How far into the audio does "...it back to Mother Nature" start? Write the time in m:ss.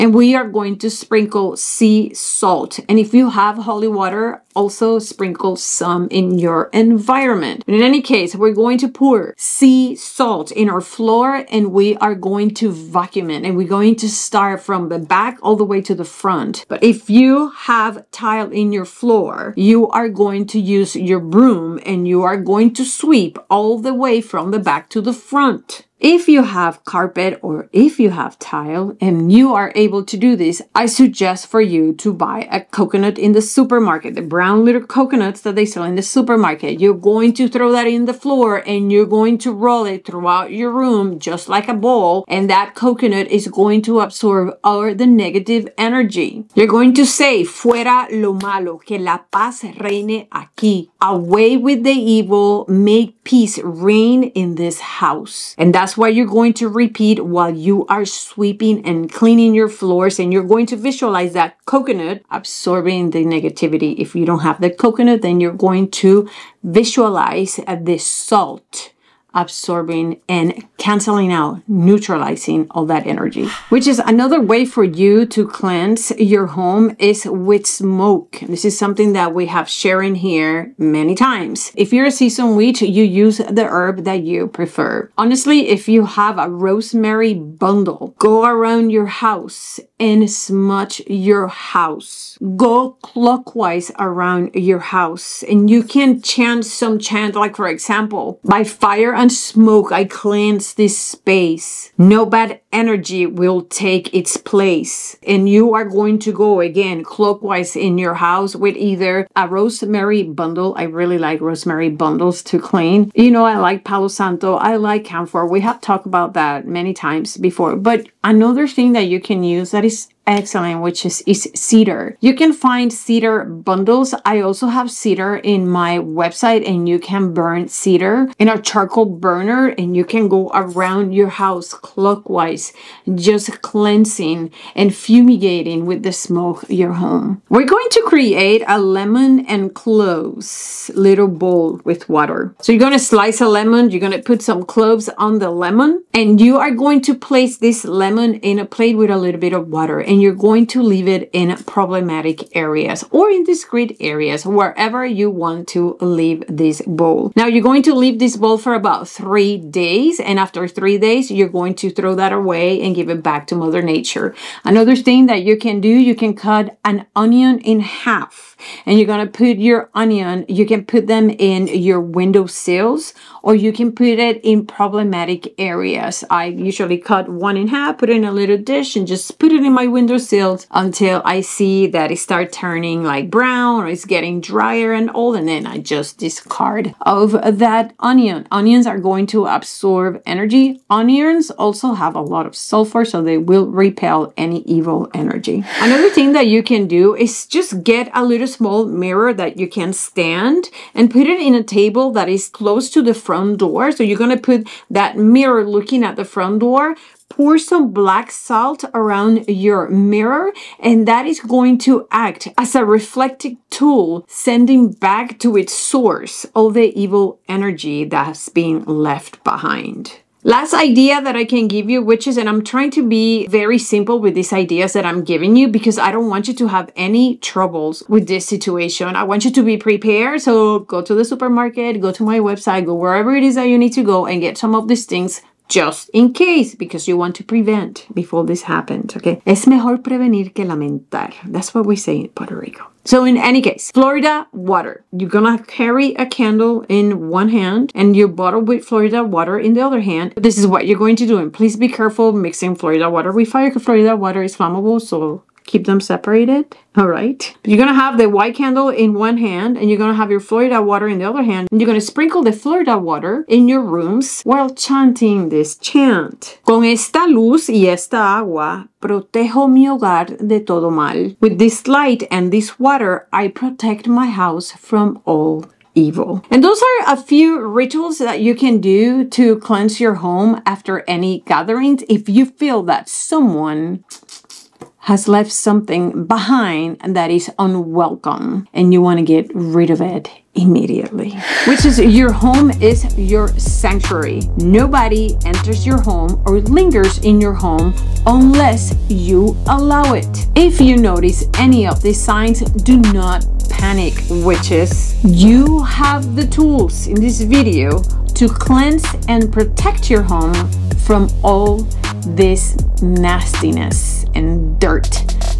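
2:43.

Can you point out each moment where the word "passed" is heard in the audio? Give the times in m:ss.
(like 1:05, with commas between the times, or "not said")
not said.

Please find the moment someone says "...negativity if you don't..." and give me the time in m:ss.
1:03.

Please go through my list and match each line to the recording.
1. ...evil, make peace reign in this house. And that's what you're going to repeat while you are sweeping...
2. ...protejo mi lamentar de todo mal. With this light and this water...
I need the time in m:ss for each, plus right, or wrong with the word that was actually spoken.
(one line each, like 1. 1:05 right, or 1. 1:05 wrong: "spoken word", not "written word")
1. 0:51 right
2. 4:28 wrong: "hogar", not "lamentar".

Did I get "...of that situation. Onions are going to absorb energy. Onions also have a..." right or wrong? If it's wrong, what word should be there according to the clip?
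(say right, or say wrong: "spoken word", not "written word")
wrong: "onion", not "situation".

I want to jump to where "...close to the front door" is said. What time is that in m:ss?
3:22.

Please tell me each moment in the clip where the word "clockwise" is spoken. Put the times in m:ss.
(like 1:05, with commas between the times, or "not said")
1:33, 1:47, 2:11.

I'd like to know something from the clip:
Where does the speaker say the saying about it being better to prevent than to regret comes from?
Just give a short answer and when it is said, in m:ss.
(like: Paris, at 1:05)
Puerto Rico, at 4:02.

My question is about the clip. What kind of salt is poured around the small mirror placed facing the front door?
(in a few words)
black salt.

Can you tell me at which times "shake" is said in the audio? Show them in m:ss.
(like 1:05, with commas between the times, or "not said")
not said.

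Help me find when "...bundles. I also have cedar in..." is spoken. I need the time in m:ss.
2:03.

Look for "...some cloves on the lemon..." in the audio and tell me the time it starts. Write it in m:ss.
2:24.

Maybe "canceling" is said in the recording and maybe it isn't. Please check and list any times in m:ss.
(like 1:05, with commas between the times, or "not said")
1:10.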